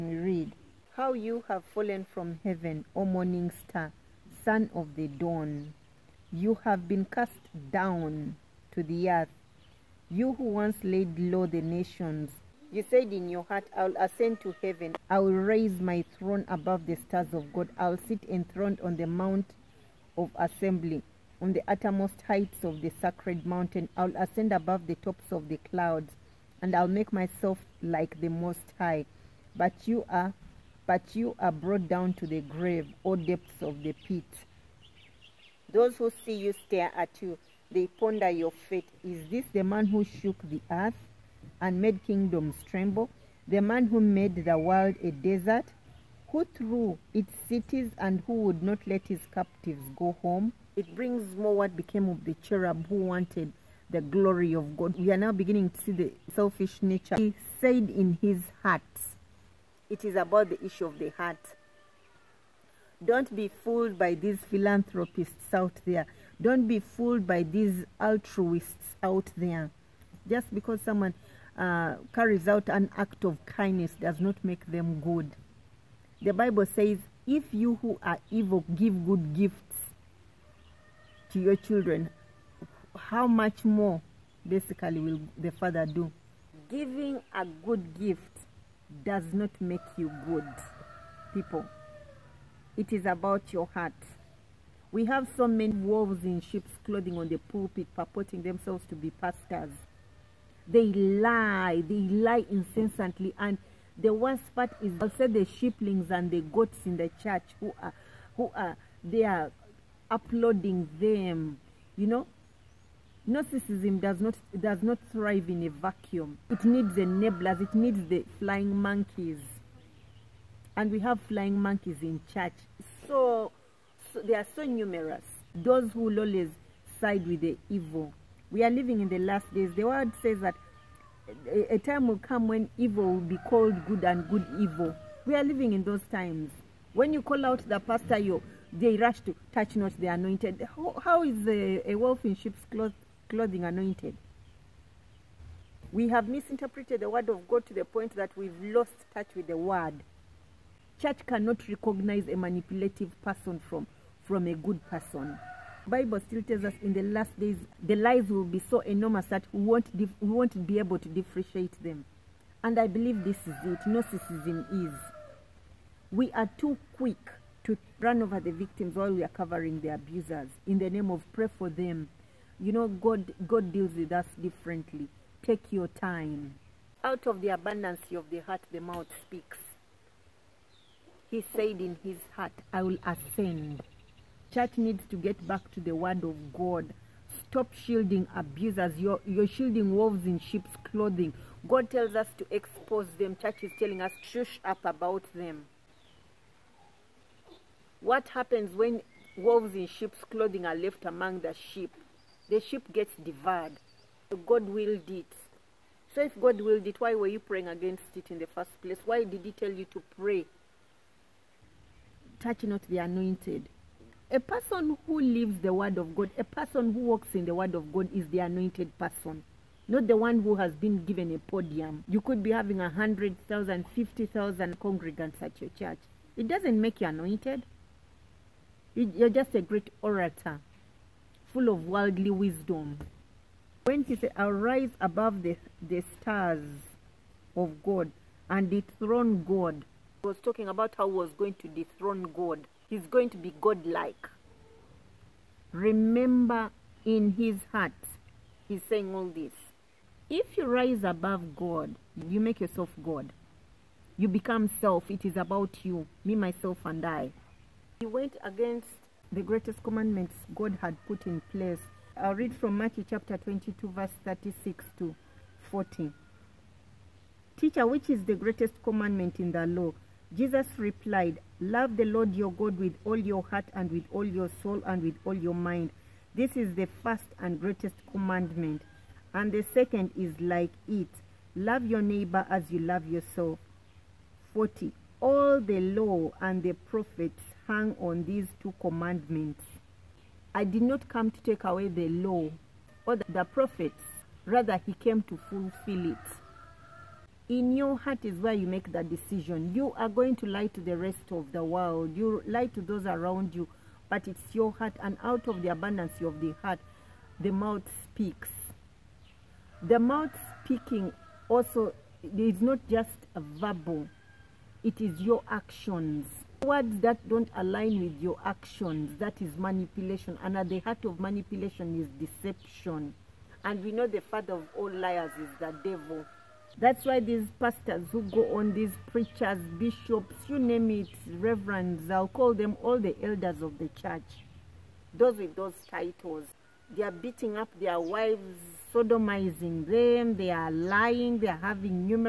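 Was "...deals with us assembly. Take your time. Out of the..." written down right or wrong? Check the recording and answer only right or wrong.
wrong.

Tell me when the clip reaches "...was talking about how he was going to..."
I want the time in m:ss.
4:00.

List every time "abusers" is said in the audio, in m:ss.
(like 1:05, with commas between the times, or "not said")
2:49, 3:08.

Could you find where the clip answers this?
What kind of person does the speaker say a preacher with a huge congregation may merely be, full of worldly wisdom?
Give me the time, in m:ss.
3:49.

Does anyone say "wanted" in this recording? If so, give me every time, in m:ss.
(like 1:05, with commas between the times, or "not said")
0:52.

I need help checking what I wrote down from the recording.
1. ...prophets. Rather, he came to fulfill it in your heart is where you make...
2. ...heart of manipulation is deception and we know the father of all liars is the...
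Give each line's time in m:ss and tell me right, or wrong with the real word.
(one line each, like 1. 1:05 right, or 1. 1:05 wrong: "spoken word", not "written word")
1. 4:53 right
2. 5:20 right.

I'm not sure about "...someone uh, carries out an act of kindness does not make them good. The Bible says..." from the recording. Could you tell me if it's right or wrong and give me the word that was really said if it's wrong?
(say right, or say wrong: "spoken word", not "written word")
right.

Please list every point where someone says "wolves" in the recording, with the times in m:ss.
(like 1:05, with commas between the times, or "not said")
1:35, 3:09, 3:19.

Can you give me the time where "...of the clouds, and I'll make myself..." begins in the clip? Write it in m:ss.
0:25.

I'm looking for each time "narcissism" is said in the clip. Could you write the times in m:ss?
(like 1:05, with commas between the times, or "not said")
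1:53, 2:43.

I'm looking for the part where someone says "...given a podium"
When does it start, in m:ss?
3:41.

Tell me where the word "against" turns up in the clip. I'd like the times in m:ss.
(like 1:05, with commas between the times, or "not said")
3:27, 4:18.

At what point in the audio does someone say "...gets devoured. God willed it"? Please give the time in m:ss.
3:22.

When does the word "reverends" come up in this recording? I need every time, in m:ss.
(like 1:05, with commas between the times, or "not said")
5:31.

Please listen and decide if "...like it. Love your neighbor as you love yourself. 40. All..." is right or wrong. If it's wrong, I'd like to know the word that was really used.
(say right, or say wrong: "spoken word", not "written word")
right.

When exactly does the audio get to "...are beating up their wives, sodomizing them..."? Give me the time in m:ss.
5:37.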